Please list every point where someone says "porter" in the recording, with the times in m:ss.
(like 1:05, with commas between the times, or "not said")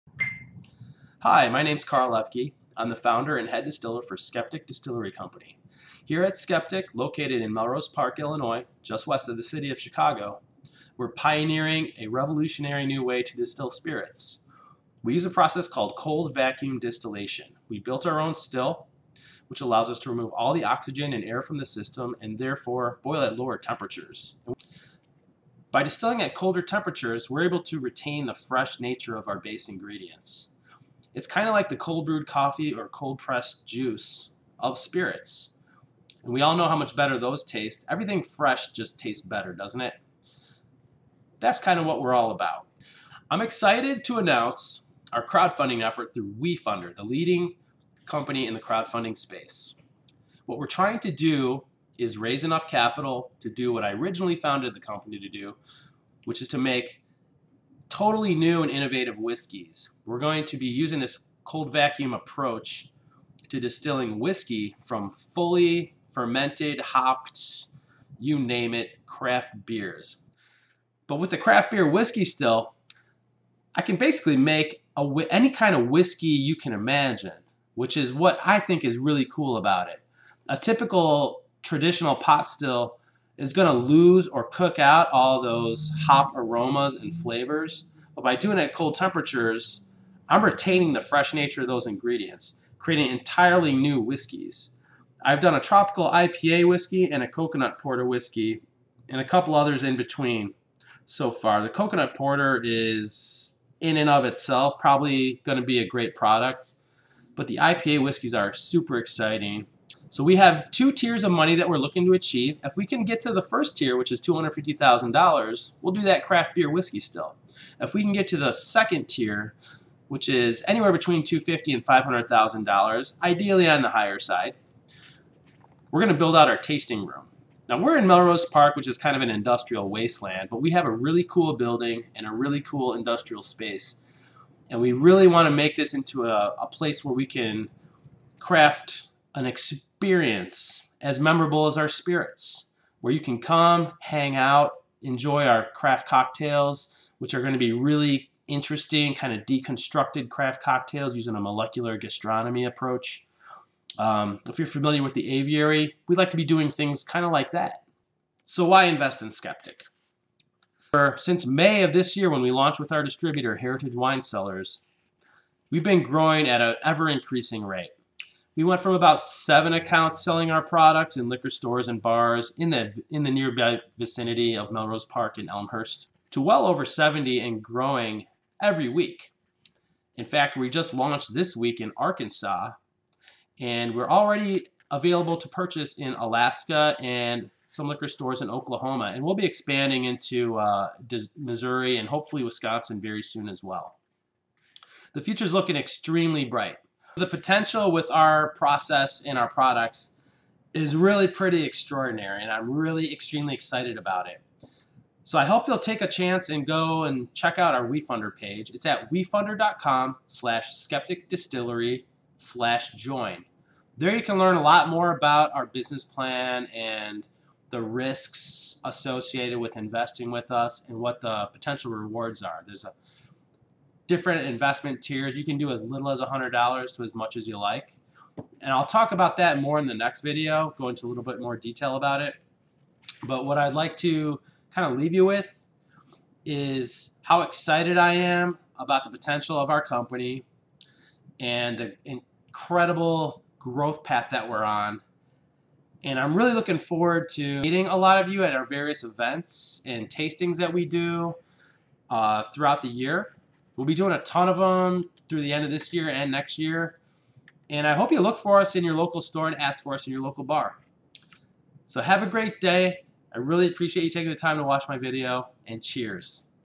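1:37, 1:42.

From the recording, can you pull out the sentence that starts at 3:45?
You can do as little as $100 to as much as you like.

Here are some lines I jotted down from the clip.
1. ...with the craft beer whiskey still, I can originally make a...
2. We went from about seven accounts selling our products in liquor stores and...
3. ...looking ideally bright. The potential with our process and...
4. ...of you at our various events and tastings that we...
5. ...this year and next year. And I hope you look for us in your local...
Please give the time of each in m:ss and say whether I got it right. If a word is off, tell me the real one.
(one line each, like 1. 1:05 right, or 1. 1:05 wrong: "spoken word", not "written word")
1. 1:11 wrong: "basically", not "originally"
2. 2:48 right
3. 3:15 wrong: "extremely", not "ideally"
4. 4:08 right
5. 4:15 right.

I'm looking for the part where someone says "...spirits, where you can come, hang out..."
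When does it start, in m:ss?
2:21.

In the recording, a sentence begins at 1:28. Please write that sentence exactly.
But by doing it at cold temperatures, I'm retaining the fresh nature of those ingredients, creating entirely new whiskeys.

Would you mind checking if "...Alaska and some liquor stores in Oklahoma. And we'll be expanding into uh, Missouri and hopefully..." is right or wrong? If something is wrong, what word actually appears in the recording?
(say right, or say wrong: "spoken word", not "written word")
right.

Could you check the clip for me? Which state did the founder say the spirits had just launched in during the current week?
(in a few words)
Arkansas.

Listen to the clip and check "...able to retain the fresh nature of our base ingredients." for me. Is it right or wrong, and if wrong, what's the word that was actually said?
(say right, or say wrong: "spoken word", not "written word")
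right.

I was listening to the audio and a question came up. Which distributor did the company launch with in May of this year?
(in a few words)
Heritage Wine Cellars.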